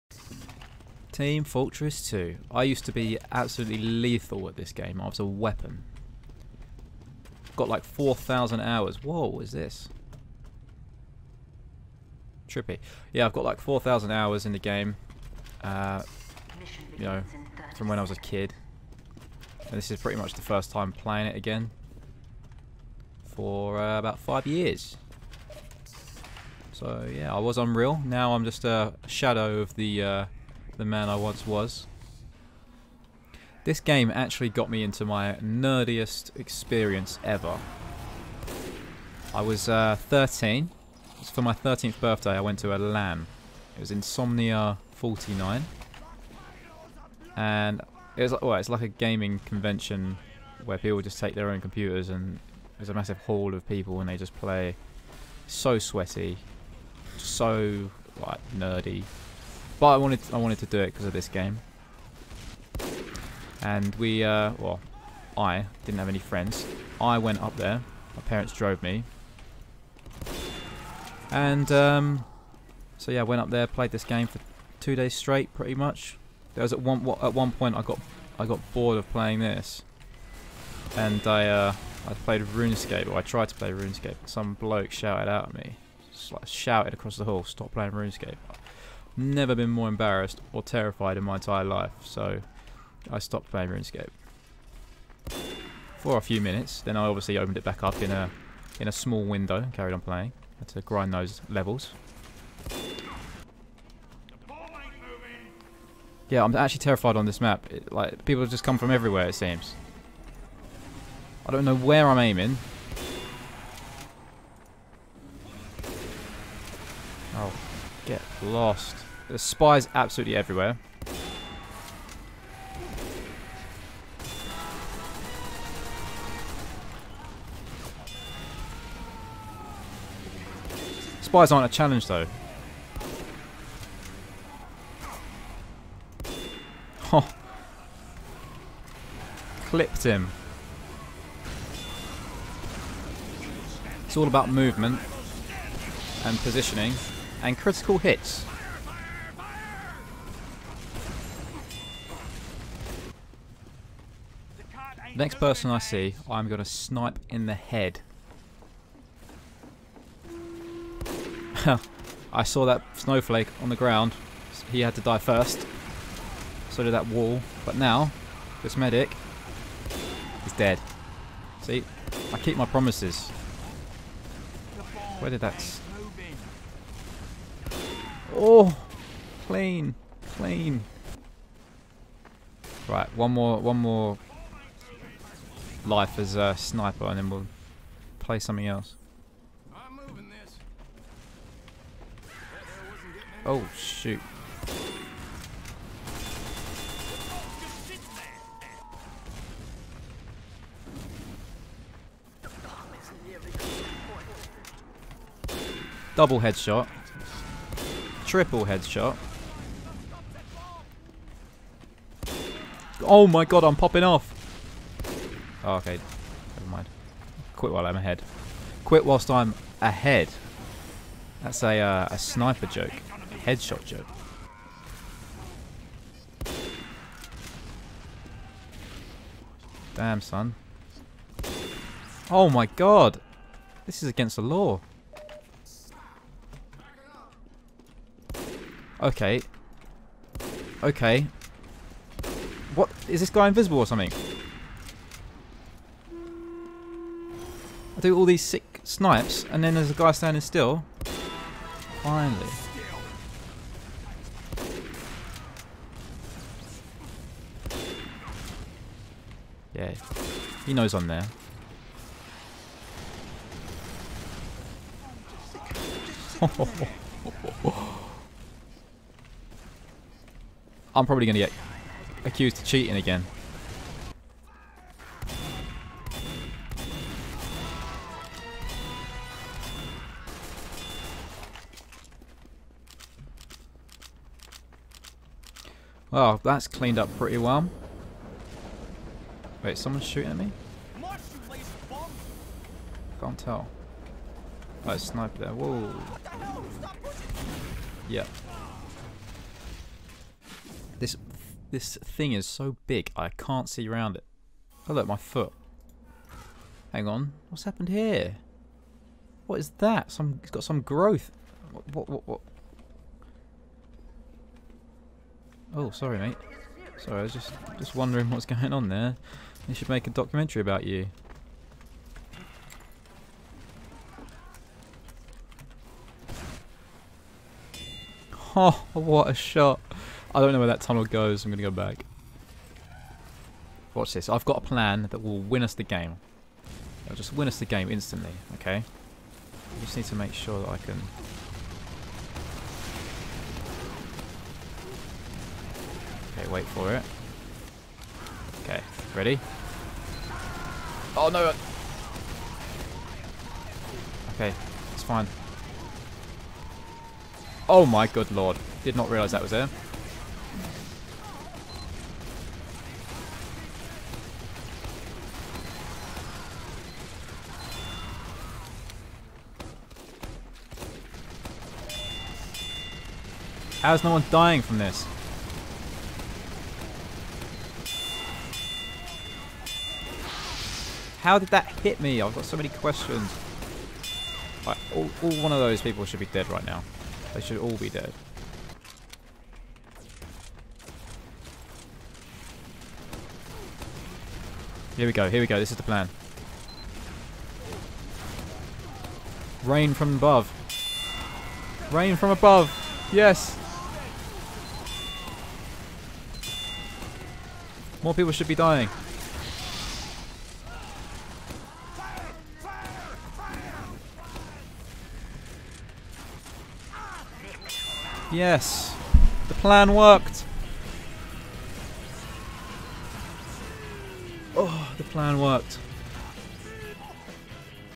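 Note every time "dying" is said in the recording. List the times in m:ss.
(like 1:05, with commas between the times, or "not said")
6:14, 6:48.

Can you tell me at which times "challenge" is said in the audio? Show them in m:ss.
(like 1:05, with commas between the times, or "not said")
2:11.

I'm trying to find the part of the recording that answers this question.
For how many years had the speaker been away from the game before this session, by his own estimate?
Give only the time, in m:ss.
0:24.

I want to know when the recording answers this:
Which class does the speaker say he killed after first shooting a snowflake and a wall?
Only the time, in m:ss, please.
2:48.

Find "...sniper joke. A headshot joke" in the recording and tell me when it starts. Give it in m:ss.
3:42.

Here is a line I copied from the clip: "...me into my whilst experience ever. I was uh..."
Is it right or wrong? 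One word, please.
wrong.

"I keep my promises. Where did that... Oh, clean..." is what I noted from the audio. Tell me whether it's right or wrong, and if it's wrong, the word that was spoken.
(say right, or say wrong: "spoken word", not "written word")
right.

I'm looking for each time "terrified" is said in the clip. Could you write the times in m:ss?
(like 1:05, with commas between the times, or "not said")
1:30, 1:46.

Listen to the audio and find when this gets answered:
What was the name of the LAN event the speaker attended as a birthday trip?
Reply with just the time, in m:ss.
0:43.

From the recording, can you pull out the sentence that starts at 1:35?
For a few minutes, then I obviously opened it back up in a in a small window and carried on playing.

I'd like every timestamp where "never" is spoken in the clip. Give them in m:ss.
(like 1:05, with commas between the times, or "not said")
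1:29, 3:36.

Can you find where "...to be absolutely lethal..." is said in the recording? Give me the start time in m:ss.
0:02.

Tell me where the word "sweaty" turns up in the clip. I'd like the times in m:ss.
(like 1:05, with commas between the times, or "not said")
0:55.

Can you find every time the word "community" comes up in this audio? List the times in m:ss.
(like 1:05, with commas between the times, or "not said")
not said.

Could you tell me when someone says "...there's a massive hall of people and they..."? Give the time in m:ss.
0:52.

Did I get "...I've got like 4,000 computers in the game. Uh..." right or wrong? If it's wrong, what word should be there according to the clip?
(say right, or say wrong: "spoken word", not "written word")
wrong: "hours", not "computers".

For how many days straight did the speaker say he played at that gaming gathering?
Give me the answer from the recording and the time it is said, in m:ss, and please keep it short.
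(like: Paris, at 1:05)
2, at 1:14.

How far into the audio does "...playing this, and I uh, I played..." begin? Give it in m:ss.
1:19.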